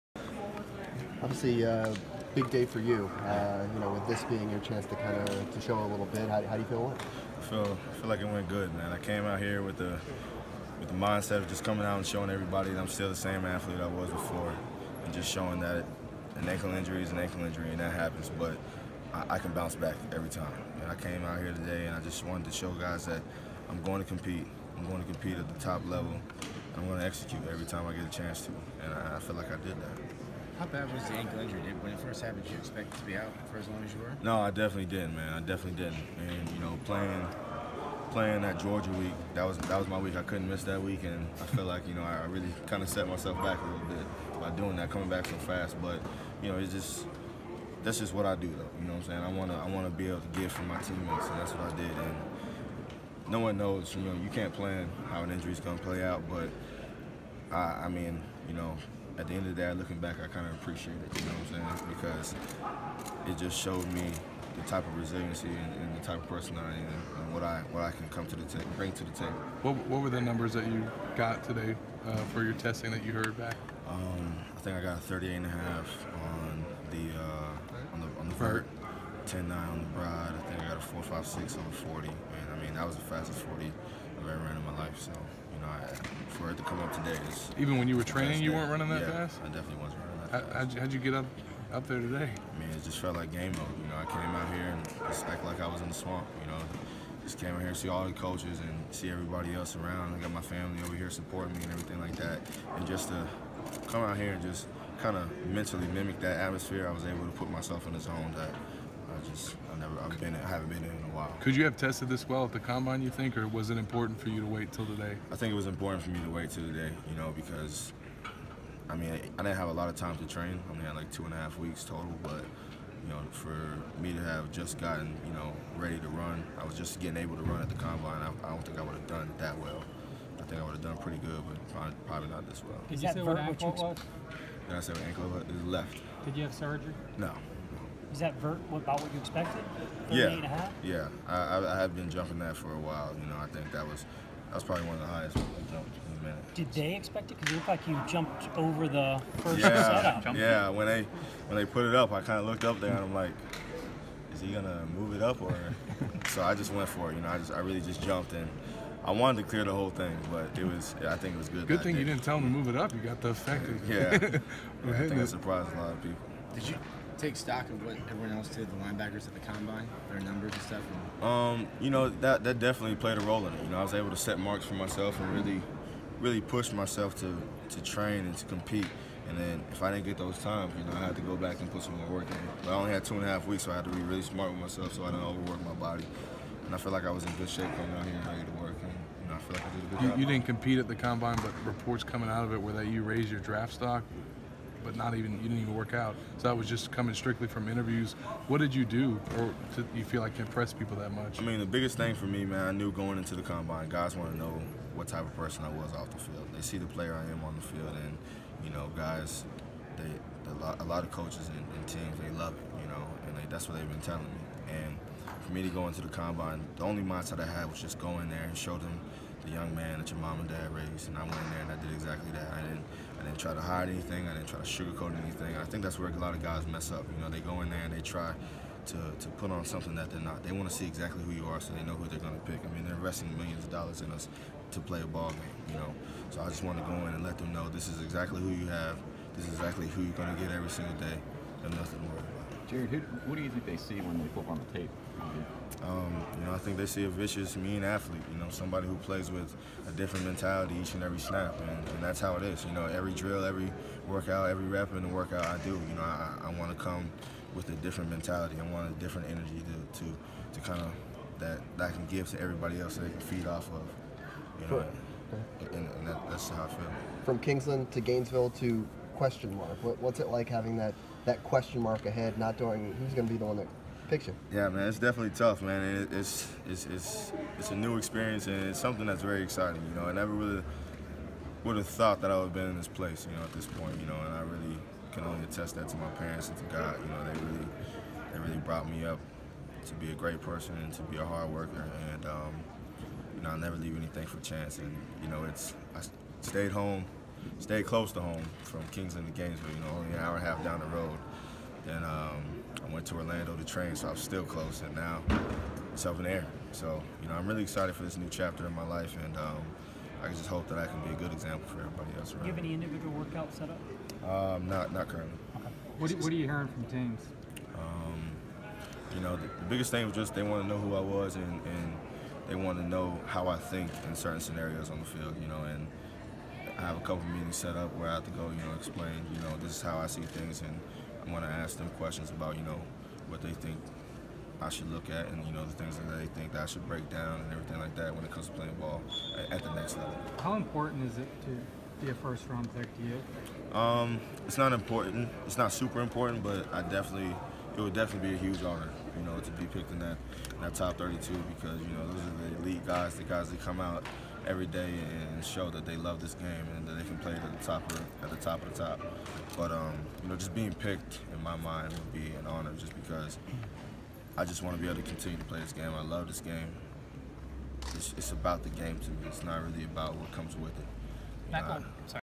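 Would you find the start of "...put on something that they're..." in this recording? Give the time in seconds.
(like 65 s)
229 s.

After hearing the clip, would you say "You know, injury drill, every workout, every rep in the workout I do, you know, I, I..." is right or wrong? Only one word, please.
wrong.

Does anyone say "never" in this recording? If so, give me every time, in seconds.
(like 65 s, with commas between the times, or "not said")
109 s, 280 s, 293 s.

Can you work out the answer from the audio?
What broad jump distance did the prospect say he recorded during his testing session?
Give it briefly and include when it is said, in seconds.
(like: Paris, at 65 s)
10-9, at 79 s.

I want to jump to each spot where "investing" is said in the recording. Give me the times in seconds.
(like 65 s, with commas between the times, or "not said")
232 s.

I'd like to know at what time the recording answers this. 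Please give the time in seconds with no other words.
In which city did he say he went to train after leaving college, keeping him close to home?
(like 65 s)
303 s.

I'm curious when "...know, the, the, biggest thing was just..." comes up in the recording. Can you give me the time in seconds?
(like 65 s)
319 s.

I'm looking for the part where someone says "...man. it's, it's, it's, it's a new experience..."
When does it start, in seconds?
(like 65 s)
275 s.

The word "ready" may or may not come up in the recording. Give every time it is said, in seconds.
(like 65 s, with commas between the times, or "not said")
125 s, 188 s.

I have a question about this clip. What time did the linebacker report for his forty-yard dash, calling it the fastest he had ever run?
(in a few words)
4.56.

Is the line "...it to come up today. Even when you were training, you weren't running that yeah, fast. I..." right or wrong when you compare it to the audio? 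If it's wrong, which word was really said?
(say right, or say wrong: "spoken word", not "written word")
right.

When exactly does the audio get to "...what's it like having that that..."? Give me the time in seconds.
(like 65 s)
269 s.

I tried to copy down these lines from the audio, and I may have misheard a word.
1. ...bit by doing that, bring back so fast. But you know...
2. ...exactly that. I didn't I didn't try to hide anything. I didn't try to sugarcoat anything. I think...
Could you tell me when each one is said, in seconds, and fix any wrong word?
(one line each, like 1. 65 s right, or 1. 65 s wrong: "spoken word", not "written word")
1. 43 s wrong: "coming", not "bring"
2. 221 s right.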